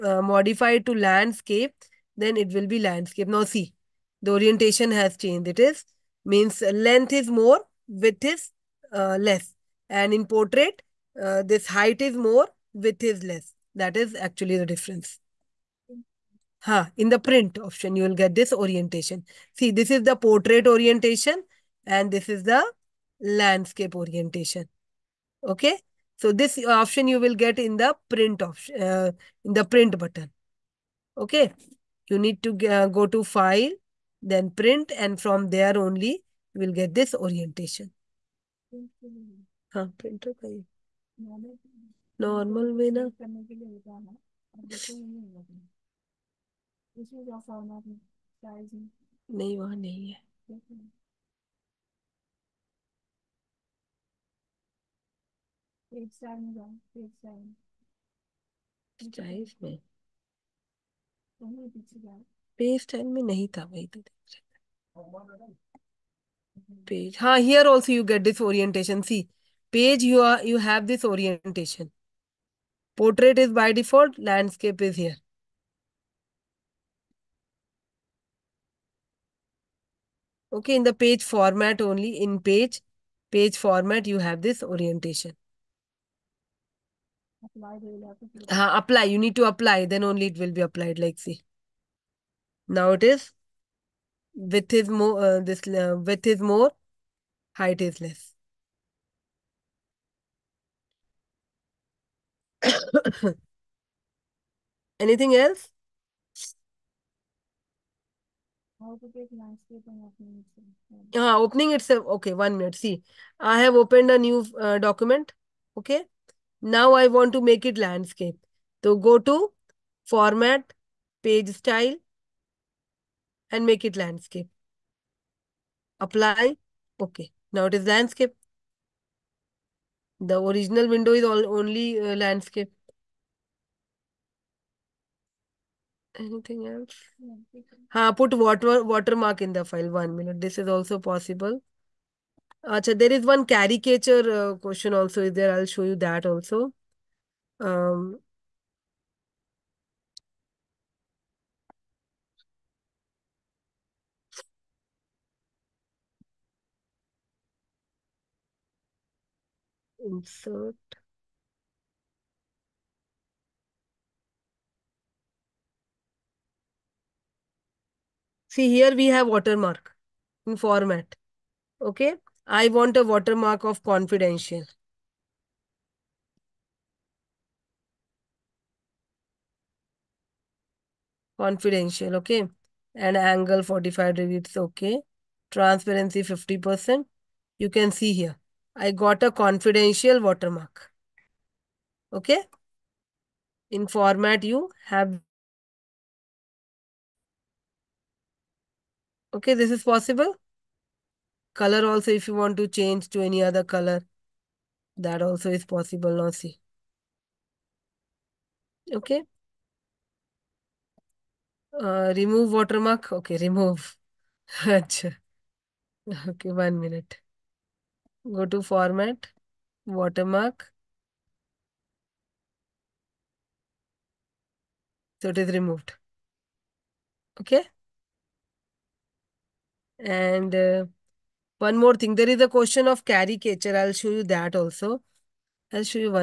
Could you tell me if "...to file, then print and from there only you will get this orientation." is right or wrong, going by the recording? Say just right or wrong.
right.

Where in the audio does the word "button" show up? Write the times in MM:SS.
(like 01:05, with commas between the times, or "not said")
00:29.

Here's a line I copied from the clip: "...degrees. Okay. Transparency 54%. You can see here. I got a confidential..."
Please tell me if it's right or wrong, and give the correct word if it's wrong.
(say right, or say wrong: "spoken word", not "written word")
wrong: "50", not "54".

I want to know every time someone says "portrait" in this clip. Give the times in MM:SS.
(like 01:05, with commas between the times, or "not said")
00:10, 00:20.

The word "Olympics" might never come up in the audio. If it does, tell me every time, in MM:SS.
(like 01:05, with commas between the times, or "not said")
not said.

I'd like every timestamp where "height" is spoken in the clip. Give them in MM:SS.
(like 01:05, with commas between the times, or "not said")
00:11, 01:37.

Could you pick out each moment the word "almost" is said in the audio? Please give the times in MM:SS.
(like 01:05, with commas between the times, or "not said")
not said.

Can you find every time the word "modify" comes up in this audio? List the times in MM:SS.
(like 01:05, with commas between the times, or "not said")
00:00.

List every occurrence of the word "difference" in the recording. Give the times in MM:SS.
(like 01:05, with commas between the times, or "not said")
00:14.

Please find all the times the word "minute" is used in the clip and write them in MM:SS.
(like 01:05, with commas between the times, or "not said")
02:20, 03:36.